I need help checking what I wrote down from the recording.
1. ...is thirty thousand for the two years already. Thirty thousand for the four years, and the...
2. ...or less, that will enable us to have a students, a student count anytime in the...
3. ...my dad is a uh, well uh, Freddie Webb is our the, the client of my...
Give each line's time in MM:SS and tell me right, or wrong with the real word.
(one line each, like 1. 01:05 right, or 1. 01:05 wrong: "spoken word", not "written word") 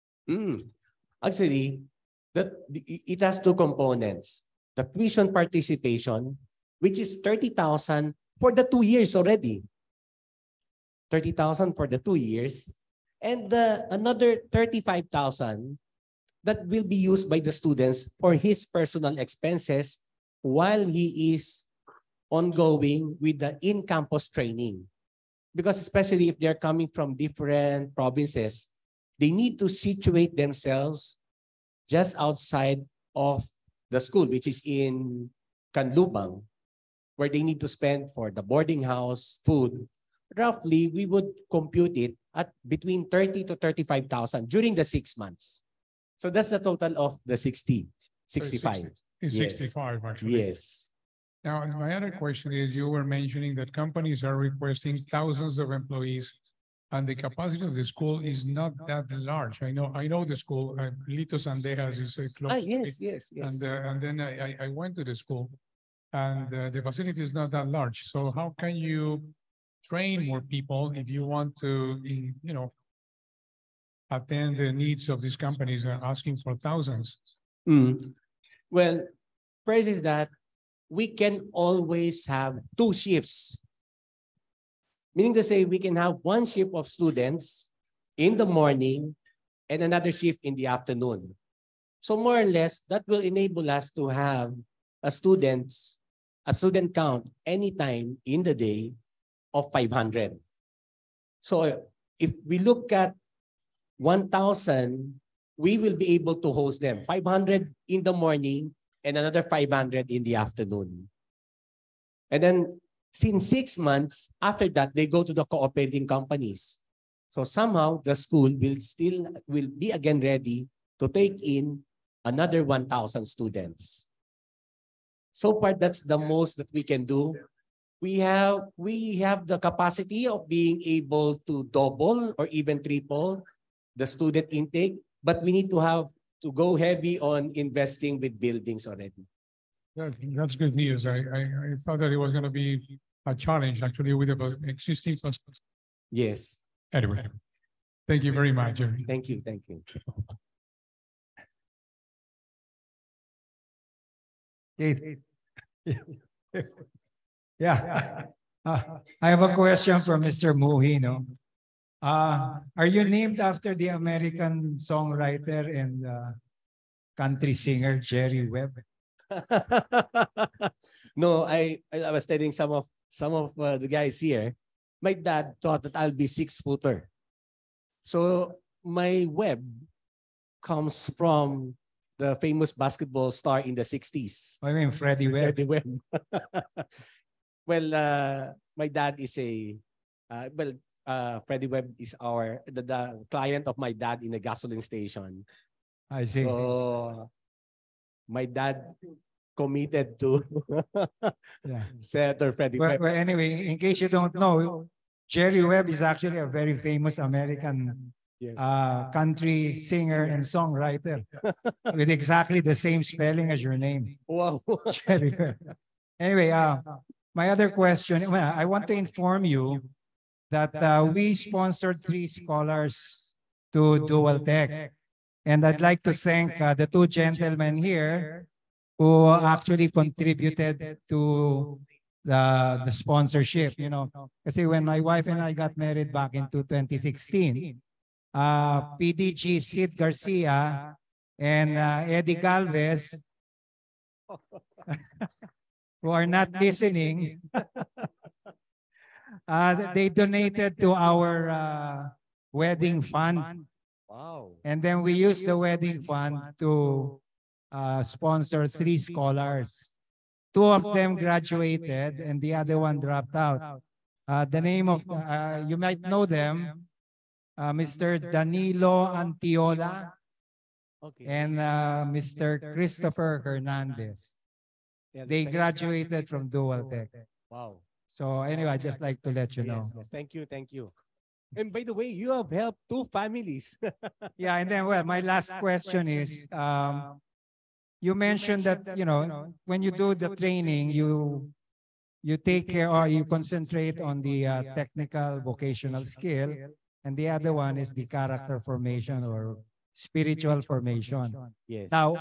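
1. 00:06 wrong: "two", not "four"
2. 01:32 right
3. 03:08 right.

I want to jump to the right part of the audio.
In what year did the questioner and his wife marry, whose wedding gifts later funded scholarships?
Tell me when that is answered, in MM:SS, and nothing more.
03:56.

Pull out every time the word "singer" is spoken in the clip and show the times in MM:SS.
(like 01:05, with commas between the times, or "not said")
02:47, 03:29.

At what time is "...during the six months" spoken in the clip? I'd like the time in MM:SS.
00:44.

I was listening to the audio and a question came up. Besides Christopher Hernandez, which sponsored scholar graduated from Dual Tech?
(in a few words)
Danilo Antiola.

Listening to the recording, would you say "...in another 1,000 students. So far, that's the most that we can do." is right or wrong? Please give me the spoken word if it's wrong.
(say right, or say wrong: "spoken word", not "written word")
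right.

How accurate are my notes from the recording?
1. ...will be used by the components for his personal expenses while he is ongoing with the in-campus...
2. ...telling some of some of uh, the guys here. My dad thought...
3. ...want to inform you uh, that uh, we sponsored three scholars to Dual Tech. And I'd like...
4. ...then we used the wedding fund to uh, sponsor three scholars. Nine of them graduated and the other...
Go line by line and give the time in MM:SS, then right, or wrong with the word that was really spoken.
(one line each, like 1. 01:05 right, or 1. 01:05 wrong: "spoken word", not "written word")
1. 00:16 wrong: "students", not "components"
2. 02:52 right
3. 03:38 right
4. 04:14 wrong: "Two", not "Nine".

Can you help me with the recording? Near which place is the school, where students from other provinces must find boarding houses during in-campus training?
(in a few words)
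Canlubang.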